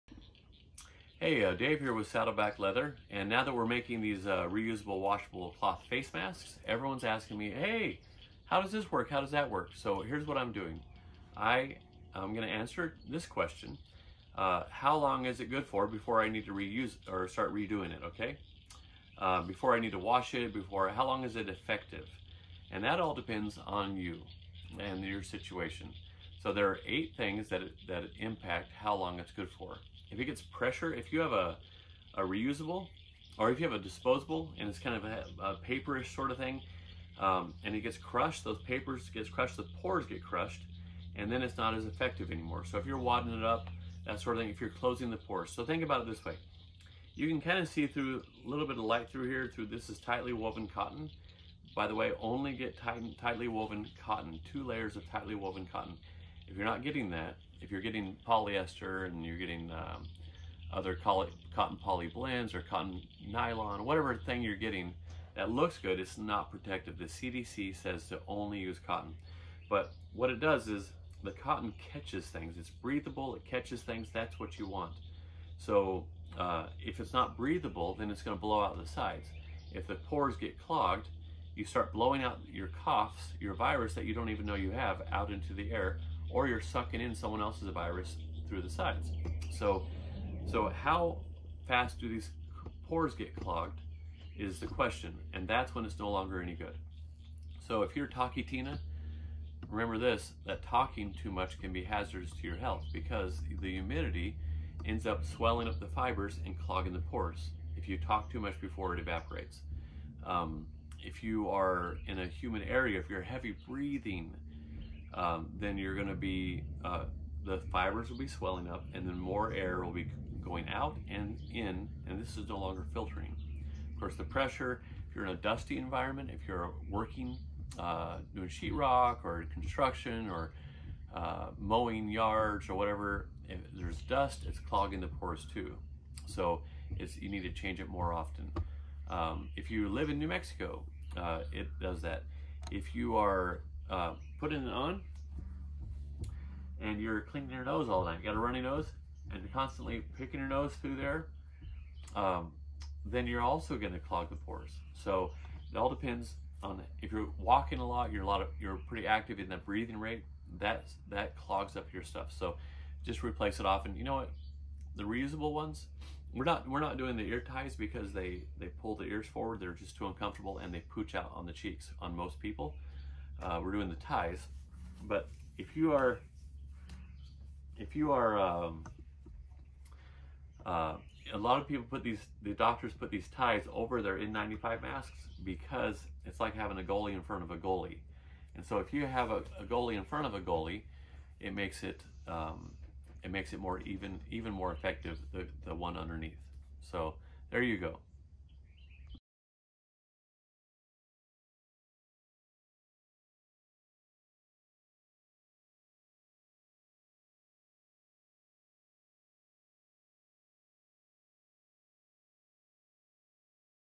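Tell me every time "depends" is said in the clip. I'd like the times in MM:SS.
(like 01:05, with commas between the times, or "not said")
00:23, 02:35.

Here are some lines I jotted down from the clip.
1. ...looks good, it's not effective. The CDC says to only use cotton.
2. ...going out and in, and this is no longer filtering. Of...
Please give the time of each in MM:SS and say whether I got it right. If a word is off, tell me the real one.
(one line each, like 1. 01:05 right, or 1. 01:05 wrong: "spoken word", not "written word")
1. 01:05 wrong: "protective", not "effective"
2. 02:00 right.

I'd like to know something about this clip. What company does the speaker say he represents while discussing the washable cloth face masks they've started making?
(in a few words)
Saddleback Leather.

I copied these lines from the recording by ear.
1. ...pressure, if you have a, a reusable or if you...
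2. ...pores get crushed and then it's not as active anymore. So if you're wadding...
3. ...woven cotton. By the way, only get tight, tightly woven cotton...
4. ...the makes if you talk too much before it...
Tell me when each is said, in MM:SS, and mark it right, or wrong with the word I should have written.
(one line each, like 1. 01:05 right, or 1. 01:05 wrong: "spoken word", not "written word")
1. 00:30 right
2. 00:39 wrong: "effective", not "active"
3. 00:50 right
4. 01:46 wrong: "pores", not "makes".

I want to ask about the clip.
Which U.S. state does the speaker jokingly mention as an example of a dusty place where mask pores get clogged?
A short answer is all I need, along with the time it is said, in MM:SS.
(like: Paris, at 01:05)
New Mexico, at 02:20.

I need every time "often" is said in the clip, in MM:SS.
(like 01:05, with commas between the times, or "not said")
02:18, 02:43.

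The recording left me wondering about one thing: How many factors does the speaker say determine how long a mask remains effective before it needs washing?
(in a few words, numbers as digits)
8.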